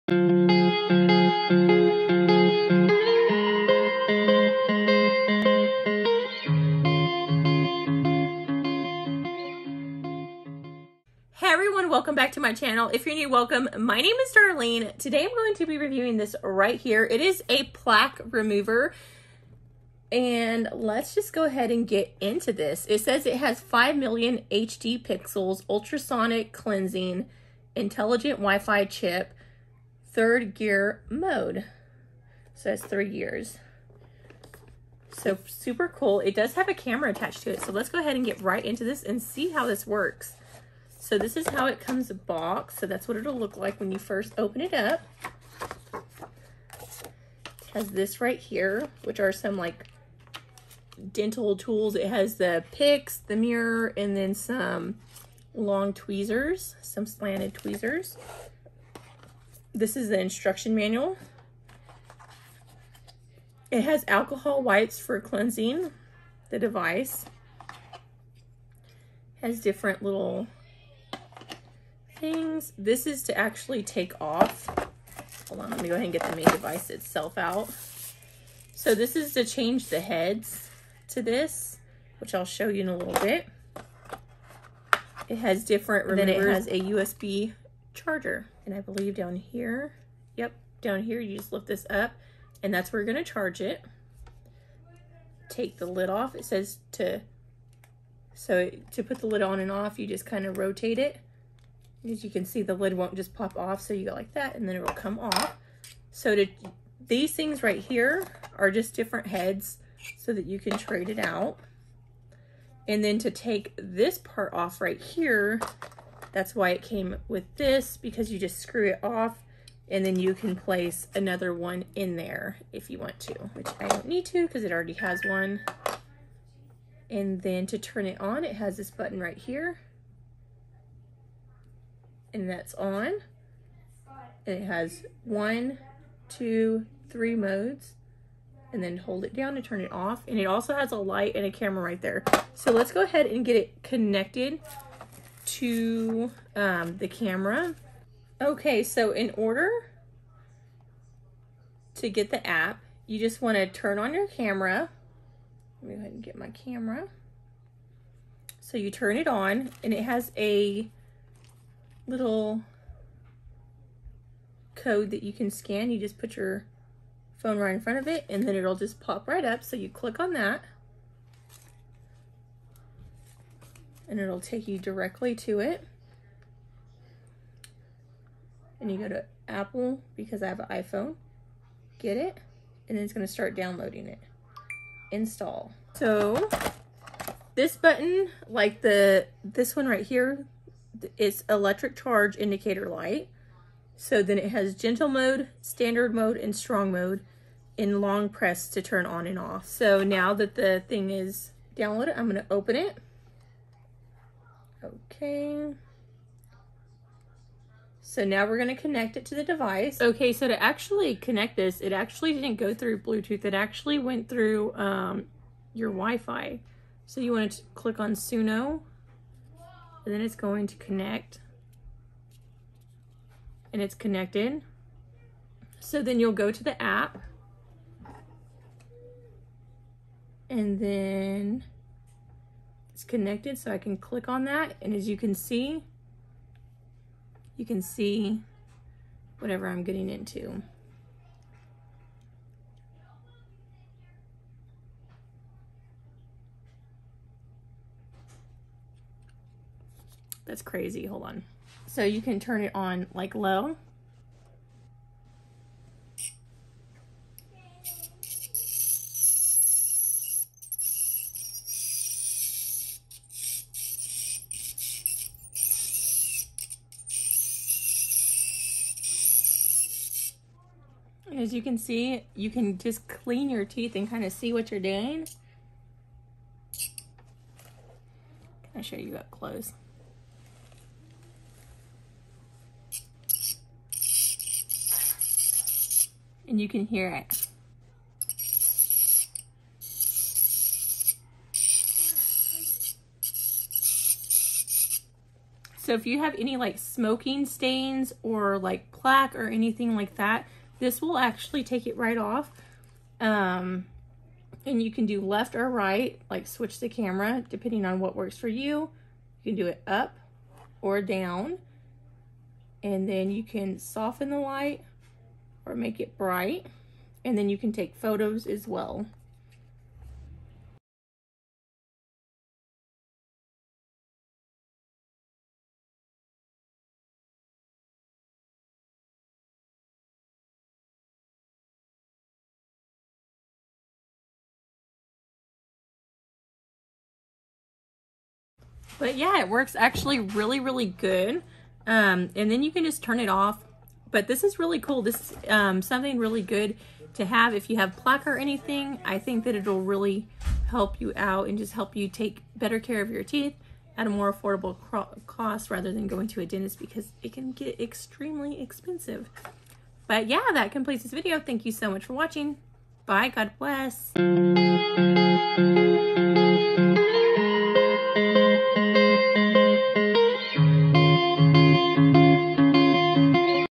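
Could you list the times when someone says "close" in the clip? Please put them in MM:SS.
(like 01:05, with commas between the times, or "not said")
04:39.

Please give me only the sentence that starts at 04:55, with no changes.
So if you have any like smoking stains or like plaque or anything like that, this will actually take it right off.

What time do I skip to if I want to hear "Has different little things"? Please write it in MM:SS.
01:09.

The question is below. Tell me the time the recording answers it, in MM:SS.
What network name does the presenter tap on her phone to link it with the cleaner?
03:38.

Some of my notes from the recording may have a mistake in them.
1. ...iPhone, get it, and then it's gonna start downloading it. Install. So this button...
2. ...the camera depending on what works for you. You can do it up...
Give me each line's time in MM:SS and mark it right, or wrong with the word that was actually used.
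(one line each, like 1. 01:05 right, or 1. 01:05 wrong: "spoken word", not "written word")
1. 03:00 right
2. 05:06 right.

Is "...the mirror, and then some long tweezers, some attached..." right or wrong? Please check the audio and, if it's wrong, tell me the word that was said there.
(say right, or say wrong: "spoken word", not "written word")
wrong: "slanted", not "attached".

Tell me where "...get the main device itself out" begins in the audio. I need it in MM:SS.
01:16.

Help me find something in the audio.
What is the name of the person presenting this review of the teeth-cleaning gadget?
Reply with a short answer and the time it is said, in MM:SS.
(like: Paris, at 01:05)
Darlene, at 00:14.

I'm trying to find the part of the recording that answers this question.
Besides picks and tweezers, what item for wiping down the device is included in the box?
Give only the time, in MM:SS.
01:04.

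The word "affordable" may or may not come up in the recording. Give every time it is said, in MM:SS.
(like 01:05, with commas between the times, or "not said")
05:54.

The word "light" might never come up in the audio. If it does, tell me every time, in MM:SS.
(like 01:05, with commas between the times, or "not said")
02:20, 03:12, 05:14.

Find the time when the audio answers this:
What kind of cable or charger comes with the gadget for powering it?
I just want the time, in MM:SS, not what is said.
01:26.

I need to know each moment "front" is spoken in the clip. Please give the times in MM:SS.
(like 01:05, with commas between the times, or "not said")
02:47.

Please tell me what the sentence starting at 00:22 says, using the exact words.
It says it has 5 million HD pixels, ultrasonic cleansing, intelligent Wi-Fi chip, third gear mode.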